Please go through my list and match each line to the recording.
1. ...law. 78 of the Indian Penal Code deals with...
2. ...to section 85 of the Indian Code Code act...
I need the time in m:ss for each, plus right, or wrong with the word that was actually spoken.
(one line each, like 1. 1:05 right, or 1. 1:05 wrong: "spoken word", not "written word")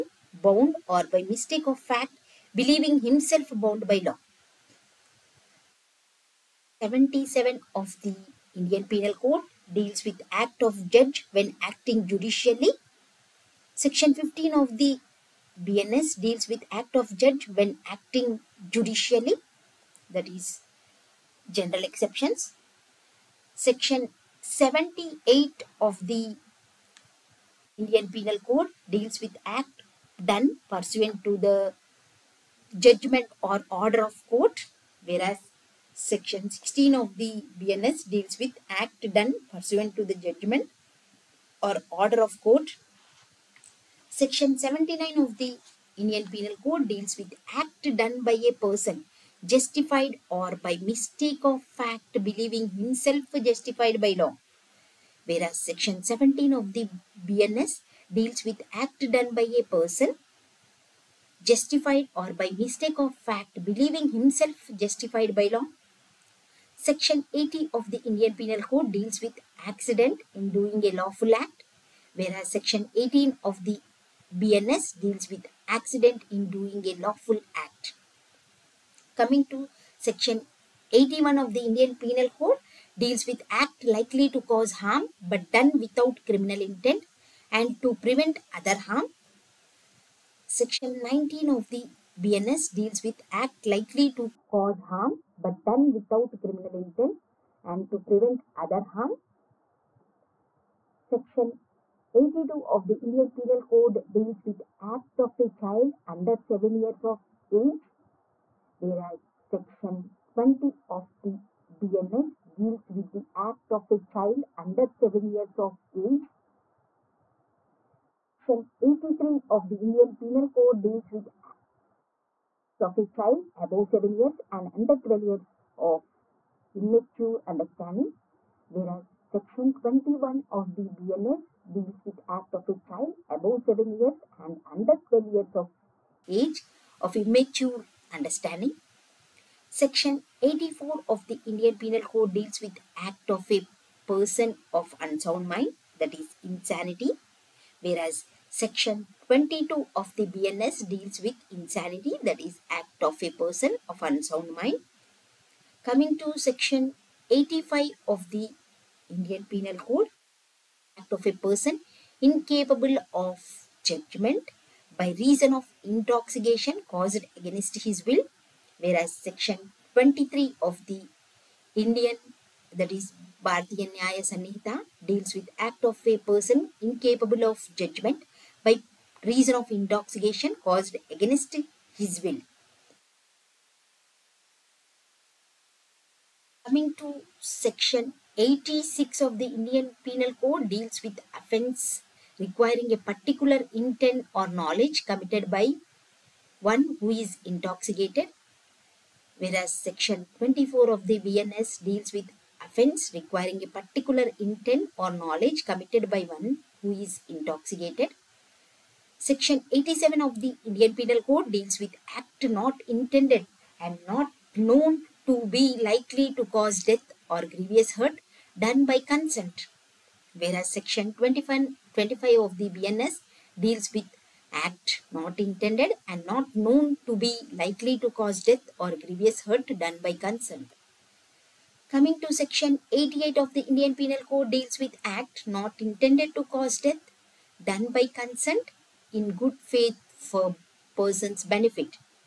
1. 0:04 wrong: "77", not "78"
2. 2:36 wrong: "Penal", not "Code".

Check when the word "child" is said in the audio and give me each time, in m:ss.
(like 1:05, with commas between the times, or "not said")
1:45, 1:53, 2:03, 2:12.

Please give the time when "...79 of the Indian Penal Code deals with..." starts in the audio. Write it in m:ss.
0:44.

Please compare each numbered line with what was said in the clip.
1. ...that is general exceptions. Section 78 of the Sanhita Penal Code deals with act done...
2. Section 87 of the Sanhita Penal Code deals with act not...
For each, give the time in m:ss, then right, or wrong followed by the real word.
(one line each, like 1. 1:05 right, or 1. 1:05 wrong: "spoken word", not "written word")
1. 0:20 wrong: "Indian", not "Sanhita"
2. 3:29 wrong: "Indian", not "Sanhita".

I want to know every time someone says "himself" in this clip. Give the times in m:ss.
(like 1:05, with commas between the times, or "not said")
0:02, 0:52, 1:04.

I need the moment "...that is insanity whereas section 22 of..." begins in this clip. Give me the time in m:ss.
2:25.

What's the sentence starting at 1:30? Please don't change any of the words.
Section 19 of the BNS deals with act likely to cause harm but done without criminal intent and to prevent other harm.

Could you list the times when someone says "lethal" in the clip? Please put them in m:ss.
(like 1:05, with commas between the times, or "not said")
not said.